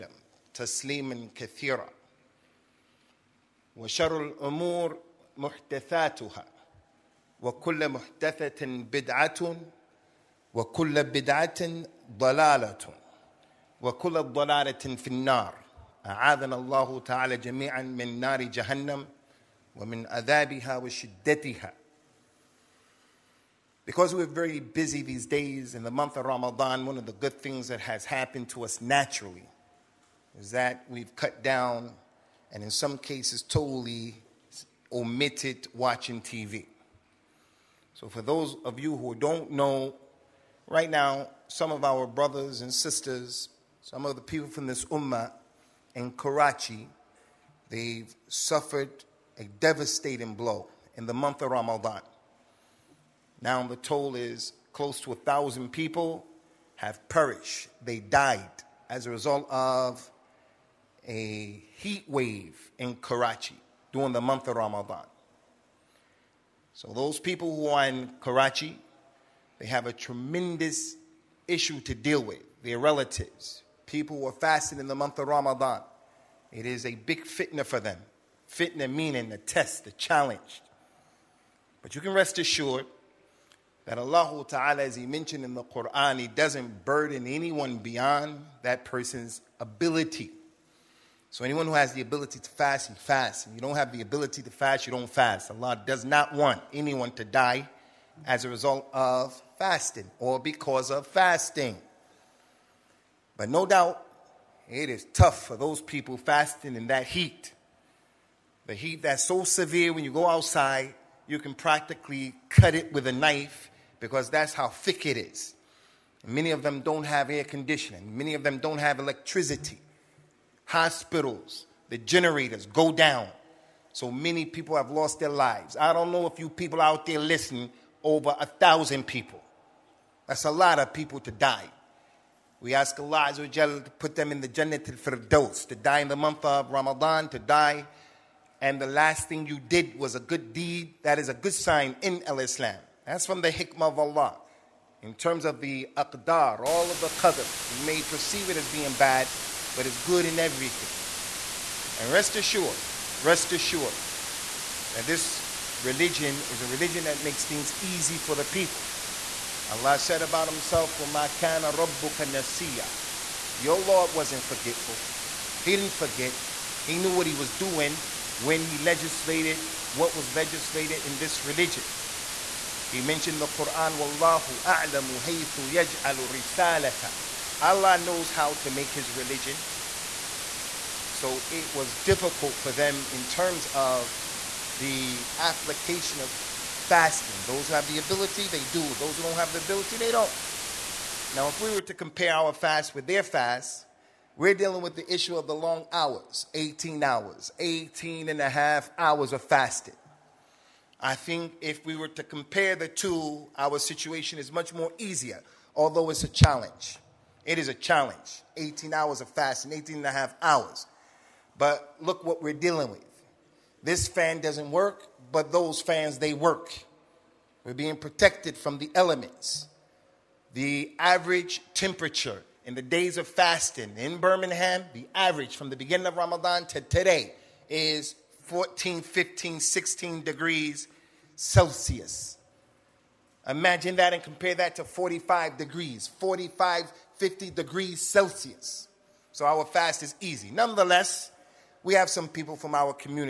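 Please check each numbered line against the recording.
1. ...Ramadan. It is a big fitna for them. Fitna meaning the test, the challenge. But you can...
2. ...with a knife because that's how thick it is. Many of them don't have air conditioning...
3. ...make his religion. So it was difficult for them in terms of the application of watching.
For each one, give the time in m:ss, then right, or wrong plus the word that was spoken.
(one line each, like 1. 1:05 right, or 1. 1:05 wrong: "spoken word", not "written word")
1. 1:15 right
2. 1:52 right
3. 2:58 wrong: "fasting", not "watching".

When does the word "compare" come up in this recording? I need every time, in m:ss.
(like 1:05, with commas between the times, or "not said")
3:11, 3:22, 3:54.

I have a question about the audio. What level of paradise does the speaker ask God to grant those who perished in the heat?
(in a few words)
Jannah al-Firdaus.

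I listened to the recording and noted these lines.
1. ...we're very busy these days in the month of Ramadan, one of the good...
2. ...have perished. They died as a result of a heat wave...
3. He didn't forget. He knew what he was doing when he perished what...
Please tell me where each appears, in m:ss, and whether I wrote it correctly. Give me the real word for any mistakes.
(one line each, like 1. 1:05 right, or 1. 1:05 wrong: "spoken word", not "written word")
1. 0:24 right
2. 0:56 right
3. 2:45 wrong: "legislated", not "perished".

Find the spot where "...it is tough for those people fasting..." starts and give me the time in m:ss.
1:44.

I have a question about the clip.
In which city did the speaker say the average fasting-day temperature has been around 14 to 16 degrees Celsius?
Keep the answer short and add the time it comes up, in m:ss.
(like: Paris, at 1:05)
Birmingham, at 3:44.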